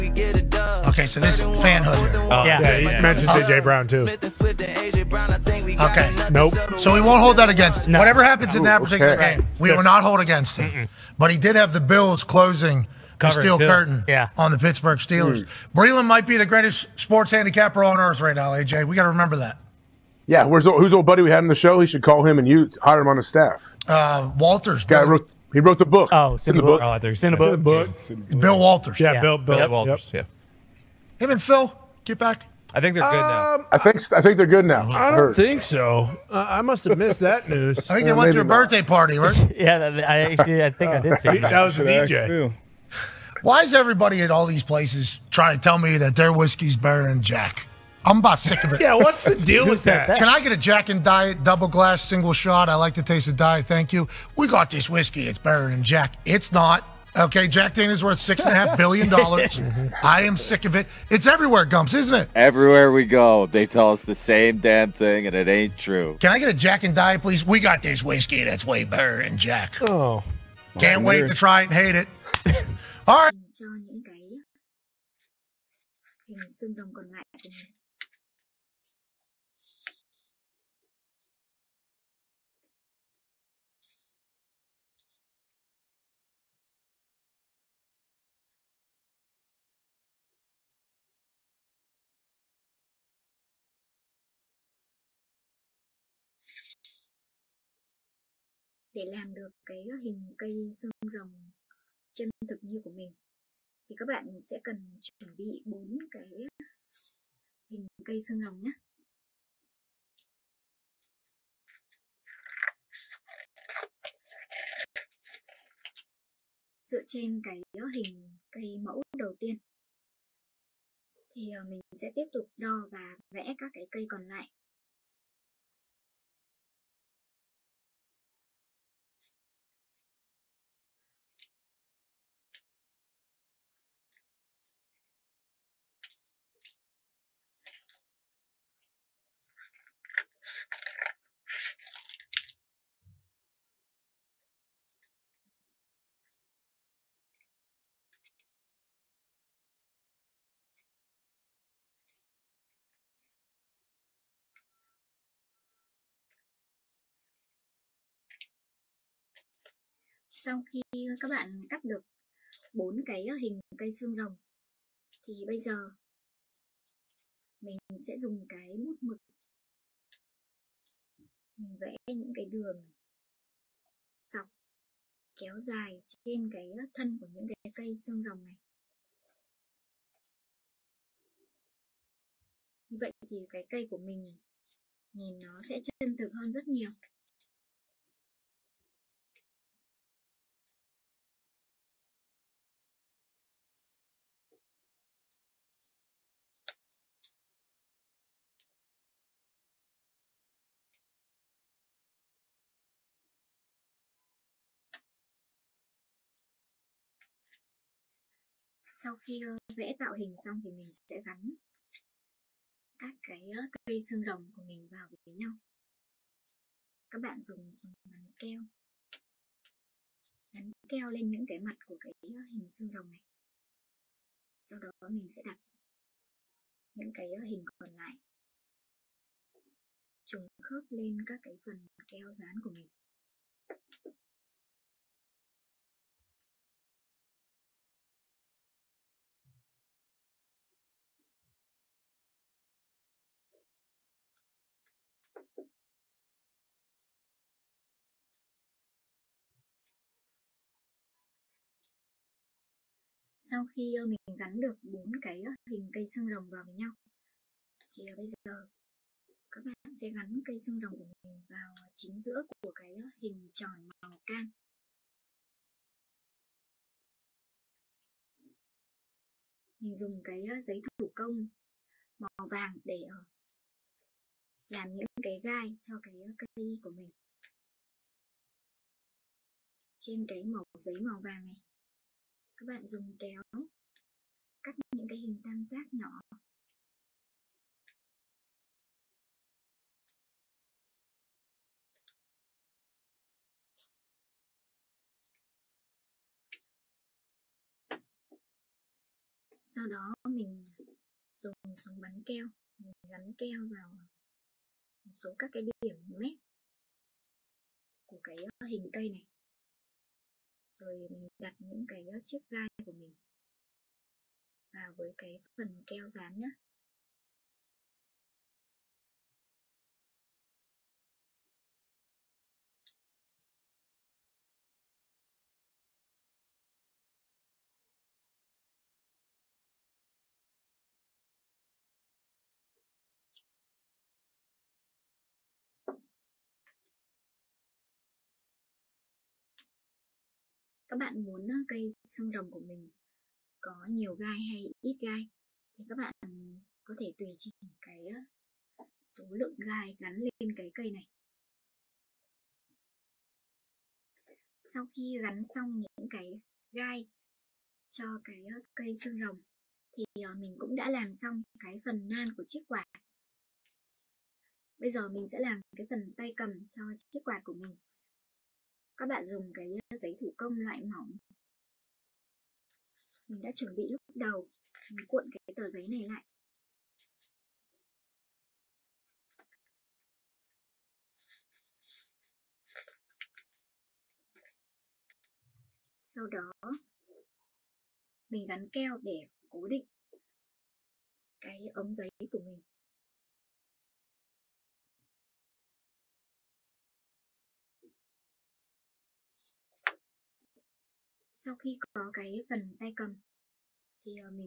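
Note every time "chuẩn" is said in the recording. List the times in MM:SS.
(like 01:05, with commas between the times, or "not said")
01:45, 06:13.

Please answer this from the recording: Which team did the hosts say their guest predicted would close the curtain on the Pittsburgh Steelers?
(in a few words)
Bills.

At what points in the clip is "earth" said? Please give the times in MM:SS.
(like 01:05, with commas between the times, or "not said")
00:17.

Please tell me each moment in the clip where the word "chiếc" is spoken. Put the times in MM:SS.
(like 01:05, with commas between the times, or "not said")
05:12, 06:02, 06:07.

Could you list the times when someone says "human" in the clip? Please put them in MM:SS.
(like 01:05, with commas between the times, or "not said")
not said.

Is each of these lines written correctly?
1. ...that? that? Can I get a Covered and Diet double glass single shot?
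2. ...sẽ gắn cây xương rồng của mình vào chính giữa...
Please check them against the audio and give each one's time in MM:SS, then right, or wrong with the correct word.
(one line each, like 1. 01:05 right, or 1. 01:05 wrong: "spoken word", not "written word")
1. 00:49 wrong: "Jack", not "Covered"
2. 04:19 right.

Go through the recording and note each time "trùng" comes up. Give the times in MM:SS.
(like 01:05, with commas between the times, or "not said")
03:50.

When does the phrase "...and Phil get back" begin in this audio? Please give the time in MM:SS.
00:31.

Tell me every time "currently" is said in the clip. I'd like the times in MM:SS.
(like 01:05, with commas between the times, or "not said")
not said.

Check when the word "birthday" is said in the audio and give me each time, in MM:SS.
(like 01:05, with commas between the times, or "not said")
00:38.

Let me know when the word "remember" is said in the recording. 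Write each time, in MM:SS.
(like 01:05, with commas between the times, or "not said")
00:19.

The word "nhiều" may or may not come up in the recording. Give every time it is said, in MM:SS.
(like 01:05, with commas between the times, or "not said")
03:06, 05:43.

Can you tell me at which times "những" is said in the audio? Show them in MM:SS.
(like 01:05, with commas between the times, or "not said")
02:52, 02:57, 03:41, 03:46, 04:34, 04:44, 05:11, 05:55.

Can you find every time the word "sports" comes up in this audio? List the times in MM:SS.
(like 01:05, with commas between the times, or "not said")
00:16.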